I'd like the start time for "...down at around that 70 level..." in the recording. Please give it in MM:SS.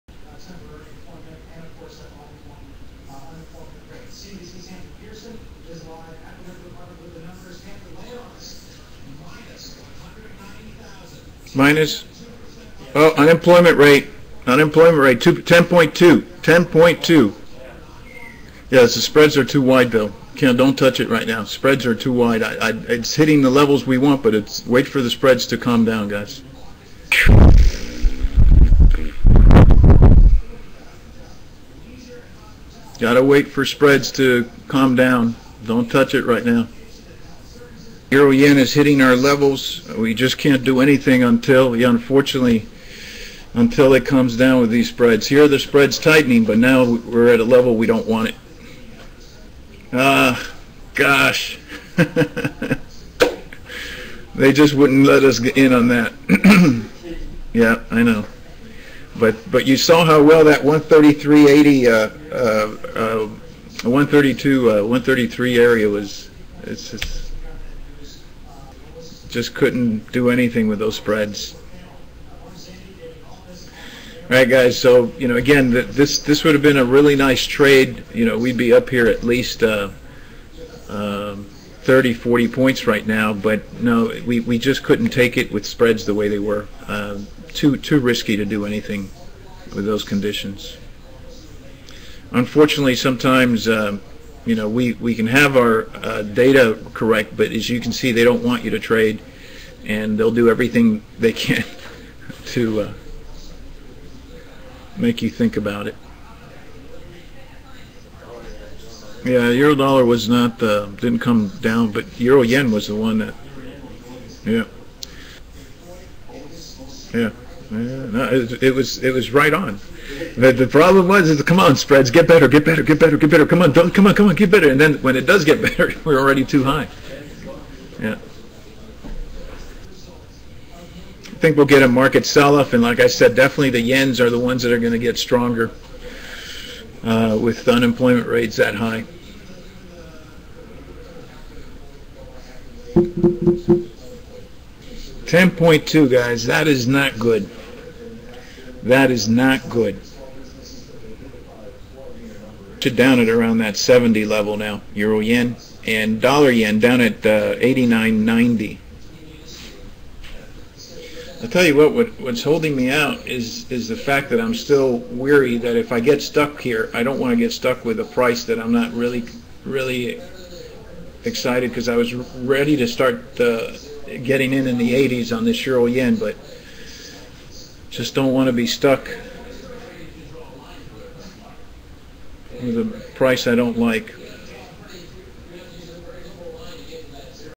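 02:32.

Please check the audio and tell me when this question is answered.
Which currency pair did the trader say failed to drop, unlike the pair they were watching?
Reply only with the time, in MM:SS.
01:49.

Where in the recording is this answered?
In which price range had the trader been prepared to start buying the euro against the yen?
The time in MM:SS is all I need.
02:54.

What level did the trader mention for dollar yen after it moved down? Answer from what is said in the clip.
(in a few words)
89.90.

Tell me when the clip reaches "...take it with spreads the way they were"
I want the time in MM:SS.
01:25.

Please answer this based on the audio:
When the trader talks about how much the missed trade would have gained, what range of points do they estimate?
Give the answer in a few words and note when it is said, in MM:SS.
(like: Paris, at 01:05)
30, 40 points, at 01:21.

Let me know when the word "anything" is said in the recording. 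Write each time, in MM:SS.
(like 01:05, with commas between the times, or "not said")
00:40, 01:10, 01:28.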